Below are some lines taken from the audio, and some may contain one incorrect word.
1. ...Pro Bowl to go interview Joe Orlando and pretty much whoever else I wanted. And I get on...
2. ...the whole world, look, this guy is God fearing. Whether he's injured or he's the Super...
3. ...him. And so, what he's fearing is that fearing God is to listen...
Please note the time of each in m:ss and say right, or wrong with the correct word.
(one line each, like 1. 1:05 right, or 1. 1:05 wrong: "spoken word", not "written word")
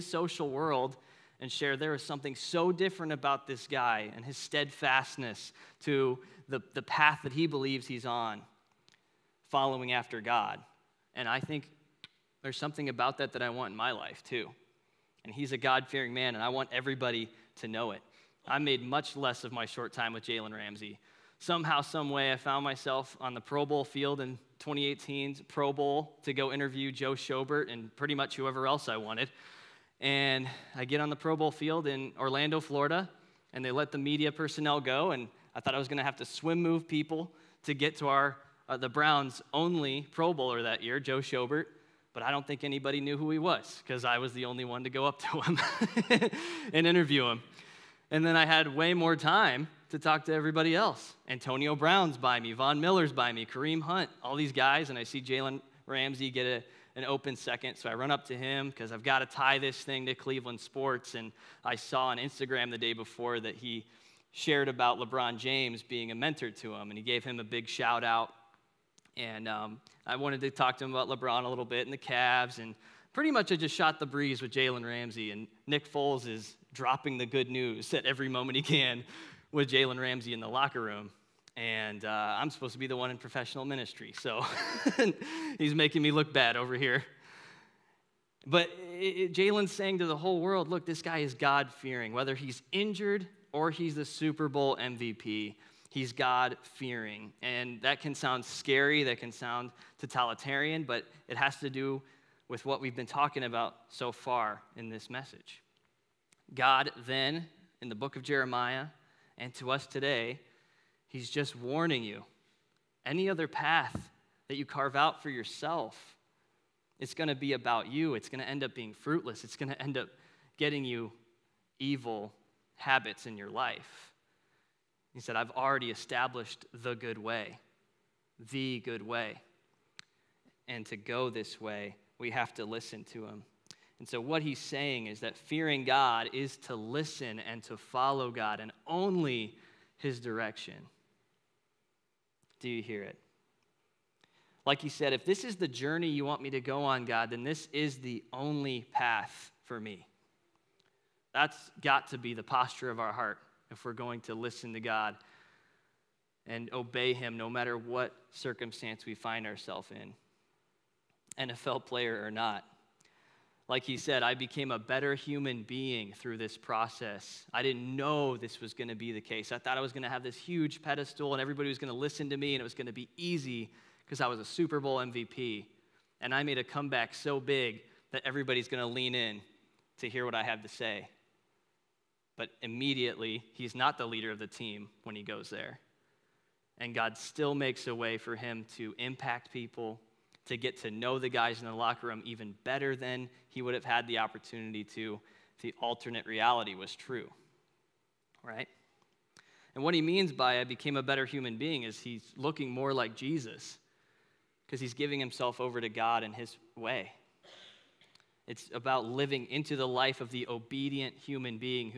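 1. 0:25 wrong: "Schobert", not "Orlando"
2. 1:30 right
3. 2:13 wrong: "saying", not "fearing".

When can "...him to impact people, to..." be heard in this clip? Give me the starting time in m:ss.
3:08.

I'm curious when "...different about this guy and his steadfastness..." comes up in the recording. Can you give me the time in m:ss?
0:02.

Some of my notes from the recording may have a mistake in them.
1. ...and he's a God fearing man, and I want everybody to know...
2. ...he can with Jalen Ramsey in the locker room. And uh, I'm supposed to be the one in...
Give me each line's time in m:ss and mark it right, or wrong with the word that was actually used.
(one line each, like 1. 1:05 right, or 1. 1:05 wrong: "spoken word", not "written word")
1. 0:15 right
2. 1:18 right.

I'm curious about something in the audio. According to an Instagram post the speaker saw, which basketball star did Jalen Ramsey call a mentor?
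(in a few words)
LeBron James.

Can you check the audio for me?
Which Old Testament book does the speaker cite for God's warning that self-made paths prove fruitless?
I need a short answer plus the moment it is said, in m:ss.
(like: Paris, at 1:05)
Jeremiah, at 1:48.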